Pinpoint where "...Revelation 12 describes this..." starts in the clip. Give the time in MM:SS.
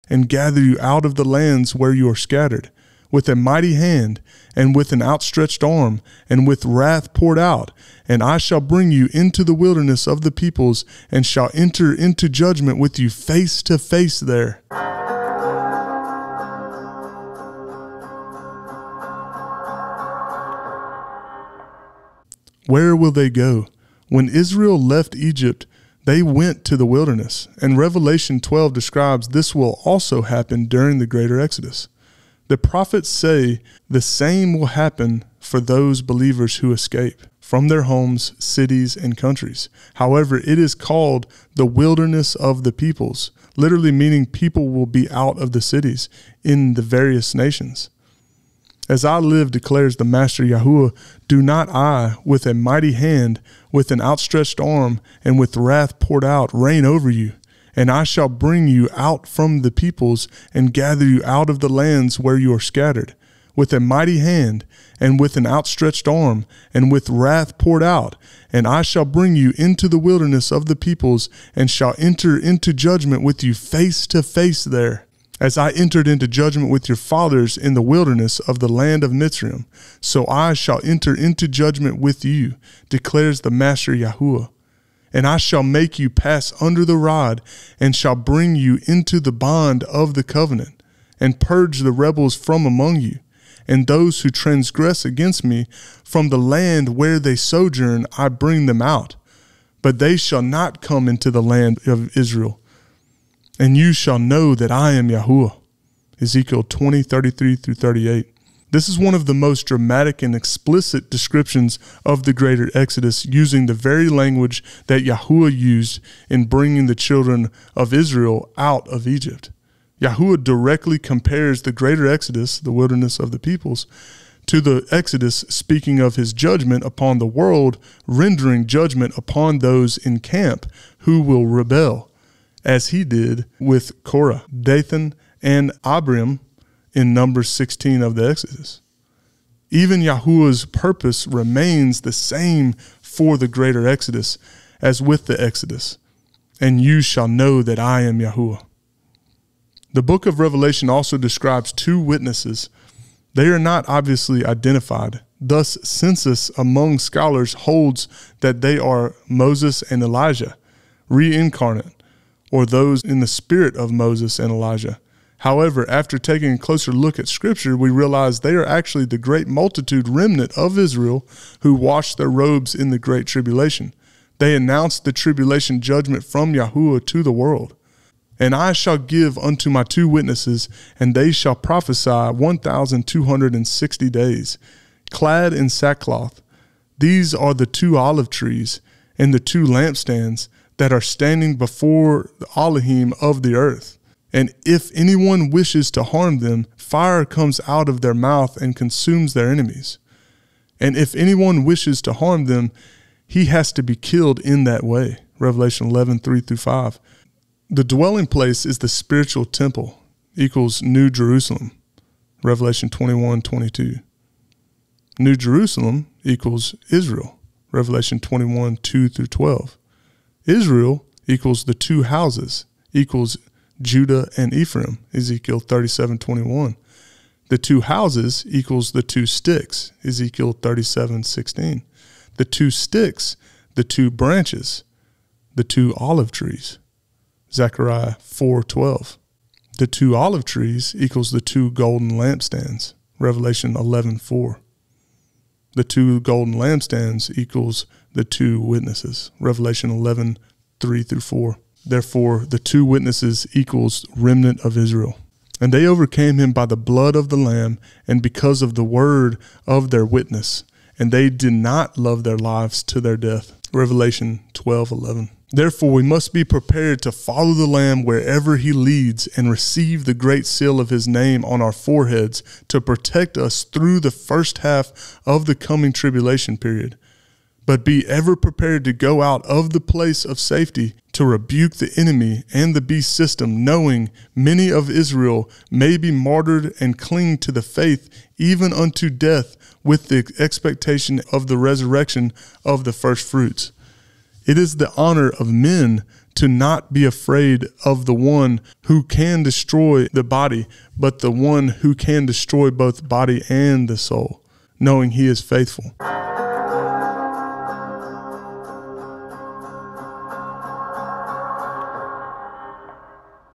00:27.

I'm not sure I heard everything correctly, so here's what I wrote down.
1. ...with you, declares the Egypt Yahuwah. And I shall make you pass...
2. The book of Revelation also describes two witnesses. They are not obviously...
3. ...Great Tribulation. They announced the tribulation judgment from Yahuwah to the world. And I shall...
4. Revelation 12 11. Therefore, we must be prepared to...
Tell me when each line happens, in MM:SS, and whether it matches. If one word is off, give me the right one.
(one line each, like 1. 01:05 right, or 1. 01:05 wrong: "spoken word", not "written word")
1. 01:21 wrong: "Master", not "Egypt"
2. 02:29 right
3. 02:52 right
4. 04:23 right.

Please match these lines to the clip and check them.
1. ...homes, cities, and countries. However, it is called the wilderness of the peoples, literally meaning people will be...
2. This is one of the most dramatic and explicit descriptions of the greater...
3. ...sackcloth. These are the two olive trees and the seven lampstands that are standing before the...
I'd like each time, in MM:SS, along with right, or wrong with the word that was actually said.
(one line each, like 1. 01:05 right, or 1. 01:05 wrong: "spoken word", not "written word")
1. 00:37 right
2. 01:48 right
3. 03:05 wrong: "two", not "seven".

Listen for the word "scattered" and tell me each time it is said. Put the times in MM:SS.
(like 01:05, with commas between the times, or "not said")
00:02, 01:02.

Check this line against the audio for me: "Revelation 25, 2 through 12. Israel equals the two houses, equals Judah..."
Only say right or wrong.
wrong.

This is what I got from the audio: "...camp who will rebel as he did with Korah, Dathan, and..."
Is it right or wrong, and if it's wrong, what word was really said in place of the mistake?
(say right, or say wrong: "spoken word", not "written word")
right.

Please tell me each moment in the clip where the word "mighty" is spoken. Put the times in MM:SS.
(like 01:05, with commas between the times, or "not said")
00:03, 00:52, 01:03.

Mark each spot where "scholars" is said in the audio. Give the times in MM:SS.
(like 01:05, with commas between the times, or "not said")
02:36.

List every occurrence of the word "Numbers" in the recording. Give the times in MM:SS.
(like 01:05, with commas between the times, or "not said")
02:17.